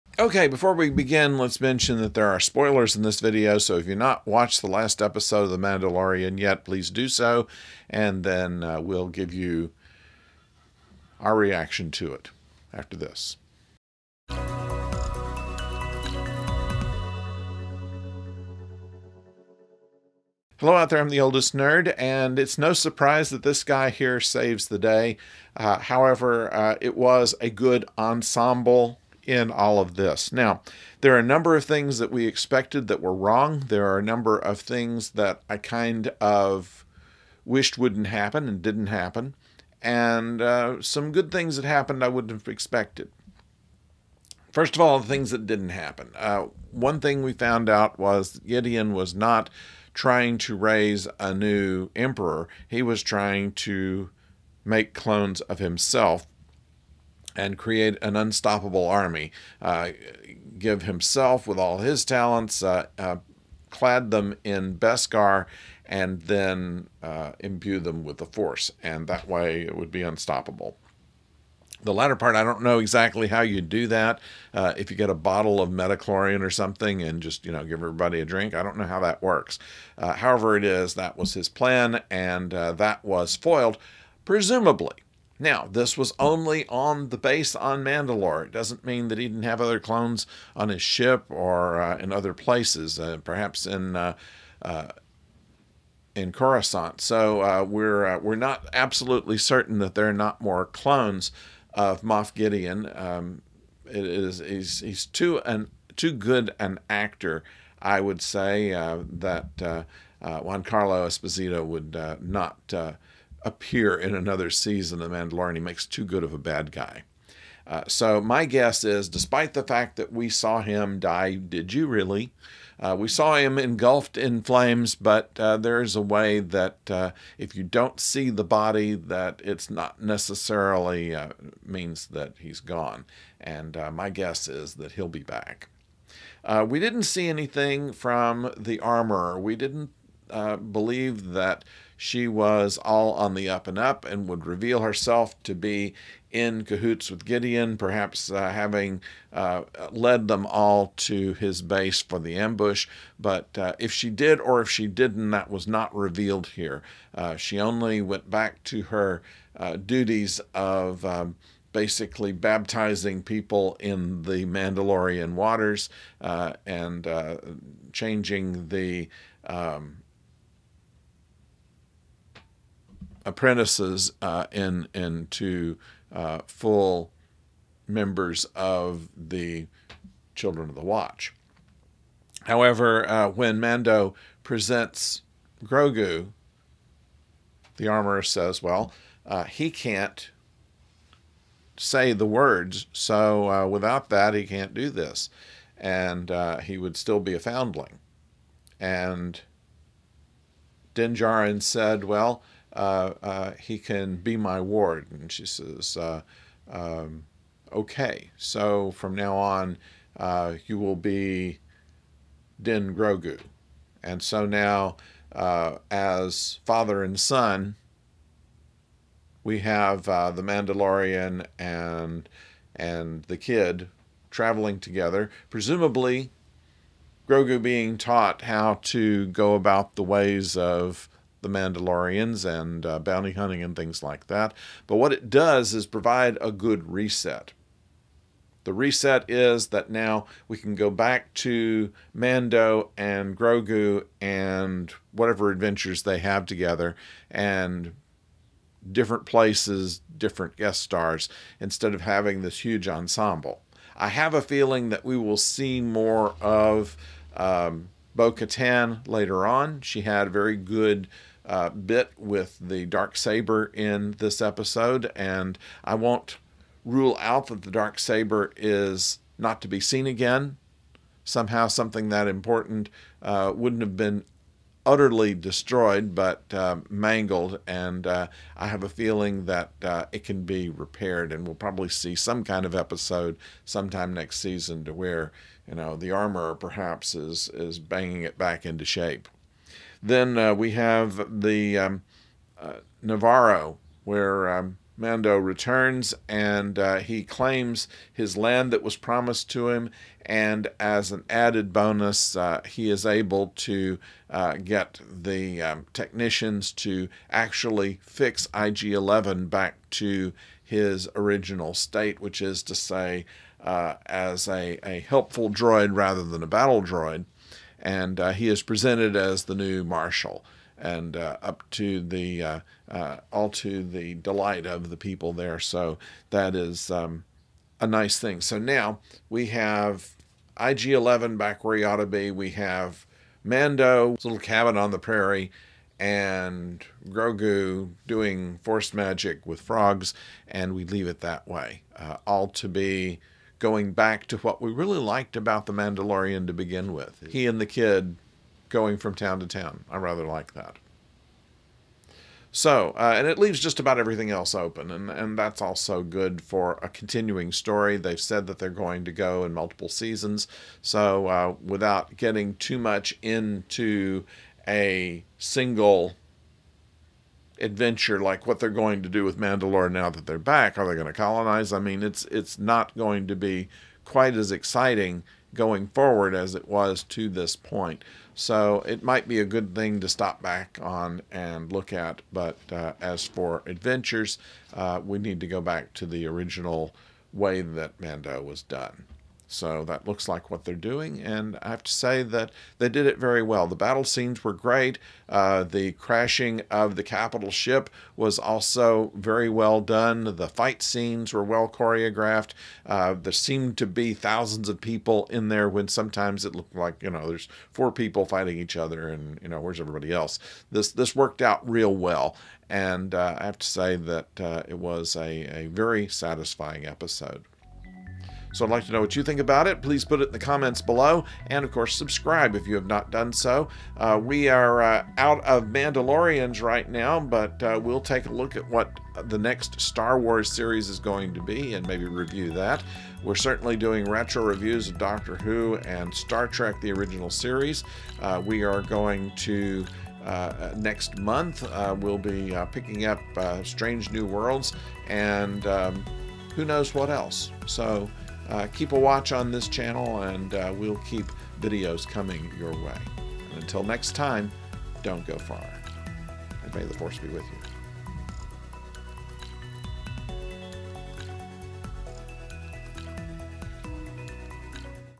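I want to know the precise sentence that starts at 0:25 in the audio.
Uh, however, uh, it was a good ensemble in all of this.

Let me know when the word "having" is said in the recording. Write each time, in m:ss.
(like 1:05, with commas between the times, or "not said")
2:28, 4:12.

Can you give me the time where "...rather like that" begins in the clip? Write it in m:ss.
5:49.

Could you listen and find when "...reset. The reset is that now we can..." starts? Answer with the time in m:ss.
3:56.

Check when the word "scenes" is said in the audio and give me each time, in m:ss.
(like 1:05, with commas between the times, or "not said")
6:34, 6:40.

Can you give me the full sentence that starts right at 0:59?
Uh, give himself with all his talents, uh, uh, clad them in Beskar, and then uh, imbue them with the force.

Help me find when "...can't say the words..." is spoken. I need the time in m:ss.
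3:09.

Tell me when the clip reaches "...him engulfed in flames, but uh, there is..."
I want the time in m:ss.
2:03.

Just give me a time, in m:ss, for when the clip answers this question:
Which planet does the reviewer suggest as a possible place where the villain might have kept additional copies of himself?
1:36.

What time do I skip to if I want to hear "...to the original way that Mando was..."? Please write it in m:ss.
6:25.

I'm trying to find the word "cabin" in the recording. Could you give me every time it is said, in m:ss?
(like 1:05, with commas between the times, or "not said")
5:34.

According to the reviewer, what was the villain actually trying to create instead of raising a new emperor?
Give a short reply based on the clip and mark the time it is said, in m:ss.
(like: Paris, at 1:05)
Clones of himself, at 0:54.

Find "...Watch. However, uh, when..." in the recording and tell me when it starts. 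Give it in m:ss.
3:00.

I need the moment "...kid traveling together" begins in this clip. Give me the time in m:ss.
3:43.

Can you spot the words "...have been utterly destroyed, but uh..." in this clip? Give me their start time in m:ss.
4:33.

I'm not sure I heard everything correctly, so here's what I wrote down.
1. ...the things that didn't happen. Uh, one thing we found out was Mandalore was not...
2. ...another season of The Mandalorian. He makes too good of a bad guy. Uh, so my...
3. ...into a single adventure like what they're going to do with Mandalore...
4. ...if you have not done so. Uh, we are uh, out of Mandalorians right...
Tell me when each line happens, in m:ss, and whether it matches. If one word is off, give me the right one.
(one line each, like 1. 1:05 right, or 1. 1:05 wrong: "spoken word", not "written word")
1. 0:44 wrong: "Gideon", not "Mandalore"
2. 1:54 right
3. 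6:03 right
4. 7:02 right.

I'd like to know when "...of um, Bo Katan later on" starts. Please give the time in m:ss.
4:16.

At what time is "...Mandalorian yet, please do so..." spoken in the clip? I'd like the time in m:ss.
0:05.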